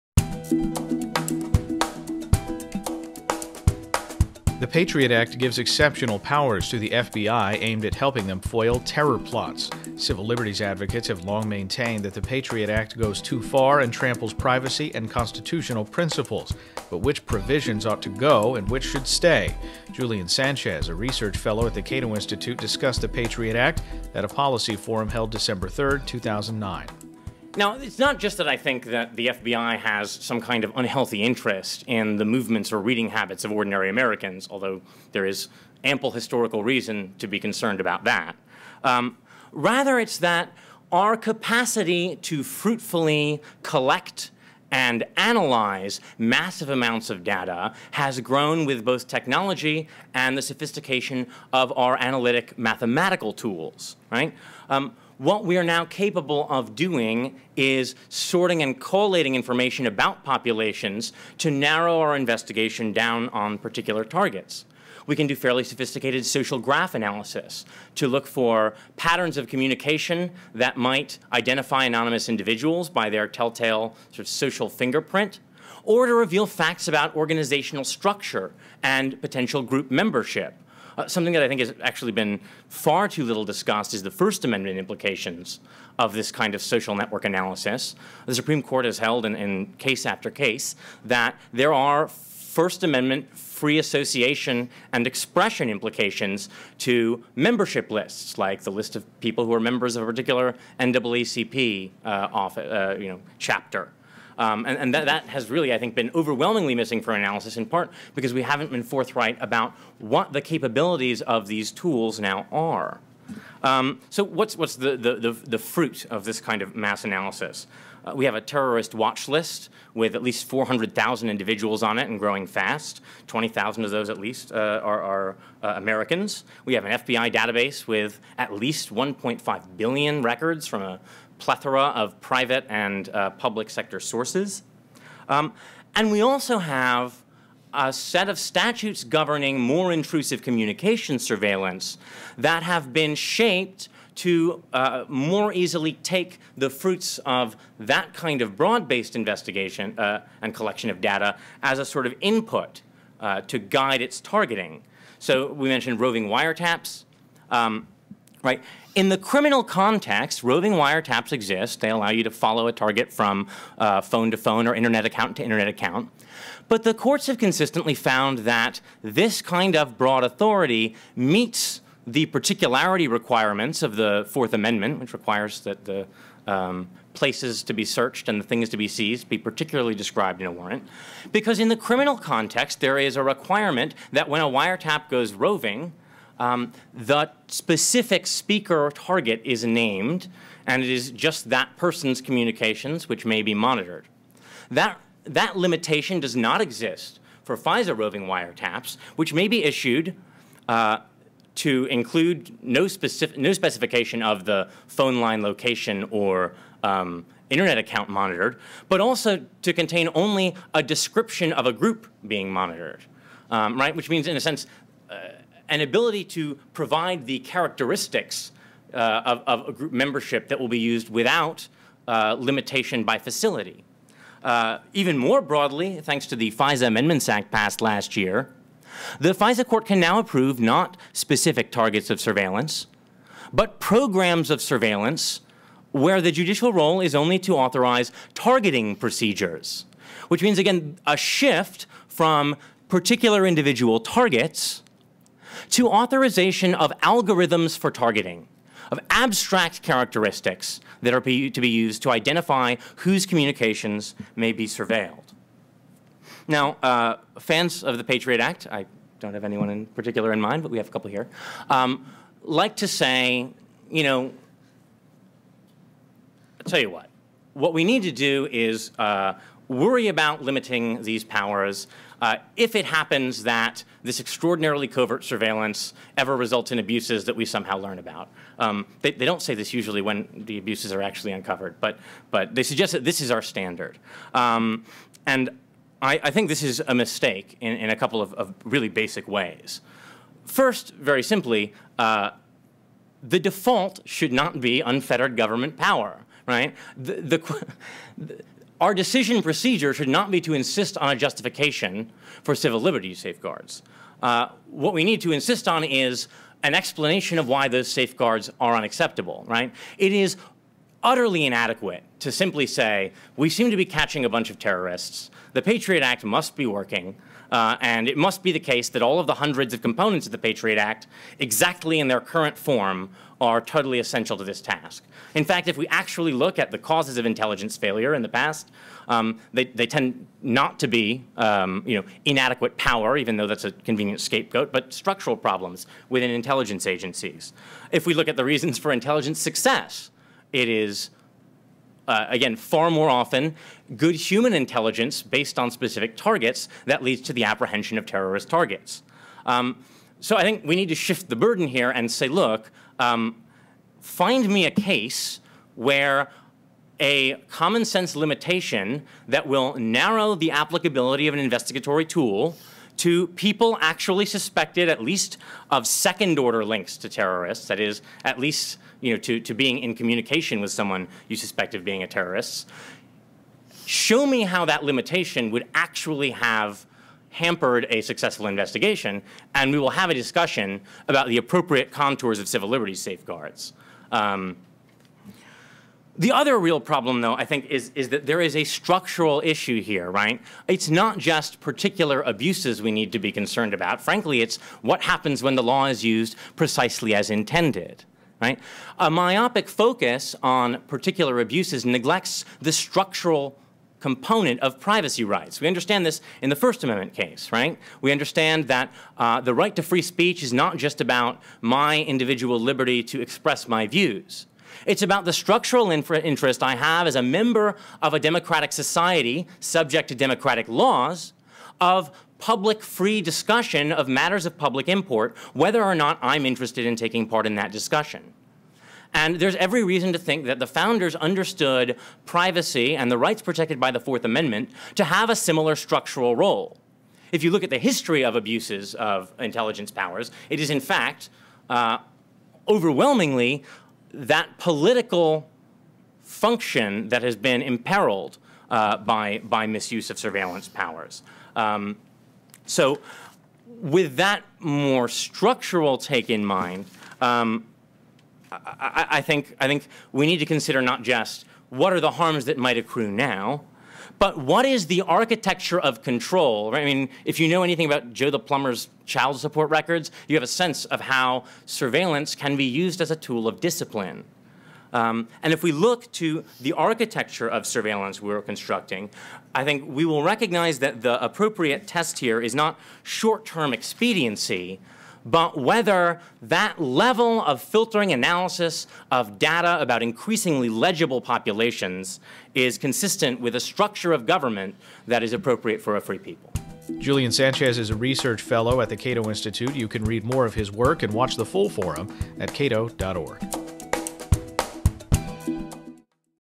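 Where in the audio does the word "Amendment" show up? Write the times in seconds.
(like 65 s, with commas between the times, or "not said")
84 s, 92 s, 174 s, 226 s, 406 s, 434 s.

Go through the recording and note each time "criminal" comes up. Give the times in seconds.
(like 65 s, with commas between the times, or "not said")
159 s, 181 s.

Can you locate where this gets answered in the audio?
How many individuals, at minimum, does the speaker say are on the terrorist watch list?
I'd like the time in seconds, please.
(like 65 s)
120 s.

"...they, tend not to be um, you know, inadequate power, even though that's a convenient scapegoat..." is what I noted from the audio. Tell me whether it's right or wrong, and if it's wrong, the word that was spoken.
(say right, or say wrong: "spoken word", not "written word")
right.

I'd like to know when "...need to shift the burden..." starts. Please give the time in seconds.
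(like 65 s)
350 s.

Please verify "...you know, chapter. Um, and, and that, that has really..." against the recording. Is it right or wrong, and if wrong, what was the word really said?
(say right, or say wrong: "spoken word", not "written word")
right.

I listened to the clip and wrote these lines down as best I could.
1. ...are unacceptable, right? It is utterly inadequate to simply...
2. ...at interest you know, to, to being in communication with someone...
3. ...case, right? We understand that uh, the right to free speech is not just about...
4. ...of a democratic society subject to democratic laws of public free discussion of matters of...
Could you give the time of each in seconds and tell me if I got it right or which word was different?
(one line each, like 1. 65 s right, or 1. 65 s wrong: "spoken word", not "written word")
1. 308 s right
2. 368 s wrong: "least", not "interest"
3. 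407 s right
4. 418 s right.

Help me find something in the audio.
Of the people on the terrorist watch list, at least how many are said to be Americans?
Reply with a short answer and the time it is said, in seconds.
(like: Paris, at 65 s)
20,000, at 123 s.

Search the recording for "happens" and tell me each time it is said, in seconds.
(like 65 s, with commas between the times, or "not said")
272 s, 395 s.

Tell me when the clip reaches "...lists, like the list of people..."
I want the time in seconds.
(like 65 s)
97 s.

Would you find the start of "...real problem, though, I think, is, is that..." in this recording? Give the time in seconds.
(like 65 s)
386 s.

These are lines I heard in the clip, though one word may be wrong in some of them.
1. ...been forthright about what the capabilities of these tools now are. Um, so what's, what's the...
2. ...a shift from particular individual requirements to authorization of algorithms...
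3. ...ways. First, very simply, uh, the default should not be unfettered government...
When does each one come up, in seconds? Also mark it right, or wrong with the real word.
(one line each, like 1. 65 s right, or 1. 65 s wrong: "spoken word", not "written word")
1. 108 s right
2. 241 s wrong: "targets", not "requirements"
3. 289 s right.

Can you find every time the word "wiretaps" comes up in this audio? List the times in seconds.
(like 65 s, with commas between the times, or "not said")
156 s, 160 s, 184 s, 198 s.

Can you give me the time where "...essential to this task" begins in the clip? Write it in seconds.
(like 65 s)
323 s.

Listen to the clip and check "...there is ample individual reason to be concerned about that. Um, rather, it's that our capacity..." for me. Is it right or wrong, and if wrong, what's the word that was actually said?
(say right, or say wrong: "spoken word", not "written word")
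wrong: "historical", not "individual".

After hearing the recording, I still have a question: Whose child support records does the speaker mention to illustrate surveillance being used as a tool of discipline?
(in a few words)
Joe the Plumber.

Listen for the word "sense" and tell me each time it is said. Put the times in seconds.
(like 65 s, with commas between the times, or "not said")
214 s, 357 s, 470 s.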